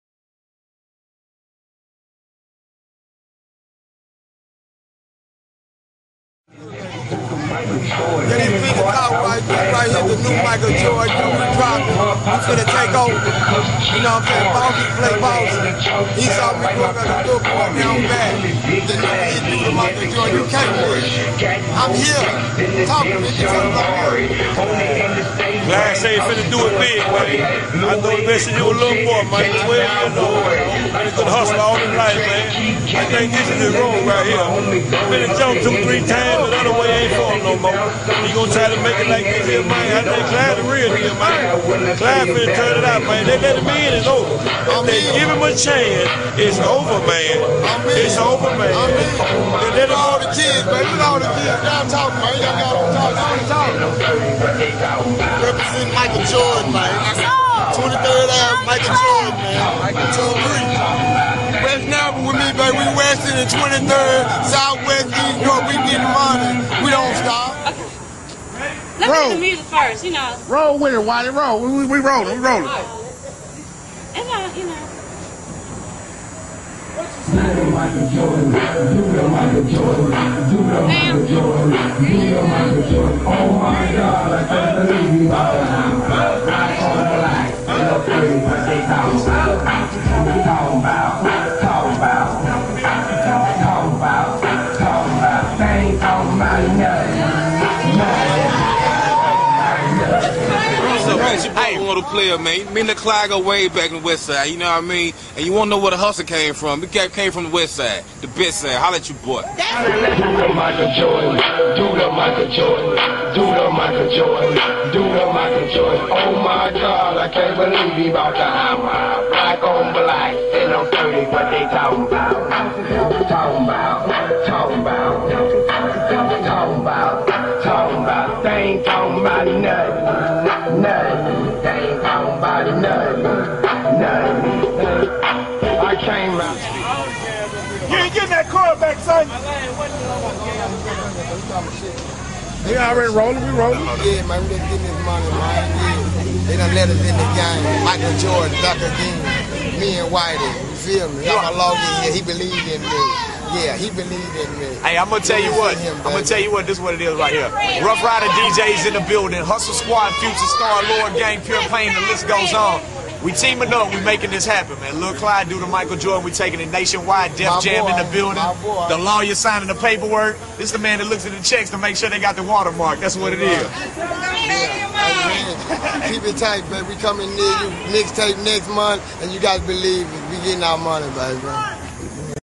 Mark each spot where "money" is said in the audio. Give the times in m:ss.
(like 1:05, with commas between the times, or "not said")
1:06, 2:25, 3:00.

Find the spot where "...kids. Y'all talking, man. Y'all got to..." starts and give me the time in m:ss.
0:51.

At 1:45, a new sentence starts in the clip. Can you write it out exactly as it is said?
And you want to know where the hustle came from.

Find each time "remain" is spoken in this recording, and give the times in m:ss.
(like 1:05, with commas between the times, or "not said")
not said.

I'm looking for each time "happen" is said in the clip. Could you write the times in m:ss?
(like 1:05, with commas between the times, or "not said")
2:44.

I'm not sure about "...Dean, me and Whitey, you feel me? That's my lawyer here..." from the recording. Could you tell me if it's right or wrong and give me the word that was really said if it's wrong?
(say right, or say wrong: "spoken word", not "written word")
right.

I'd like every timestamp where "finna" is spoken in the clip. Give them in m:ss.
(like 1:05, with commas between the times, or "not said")
0:26, 0:42.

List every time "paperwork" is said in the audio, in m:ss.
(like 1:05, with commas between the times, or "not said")
2:49.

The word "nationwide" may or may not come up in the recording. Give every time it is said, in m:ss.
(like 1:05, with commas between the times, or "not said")
2:46.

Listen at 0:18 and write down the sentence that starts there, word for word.
The new hit the Michael Jordan, you can't win.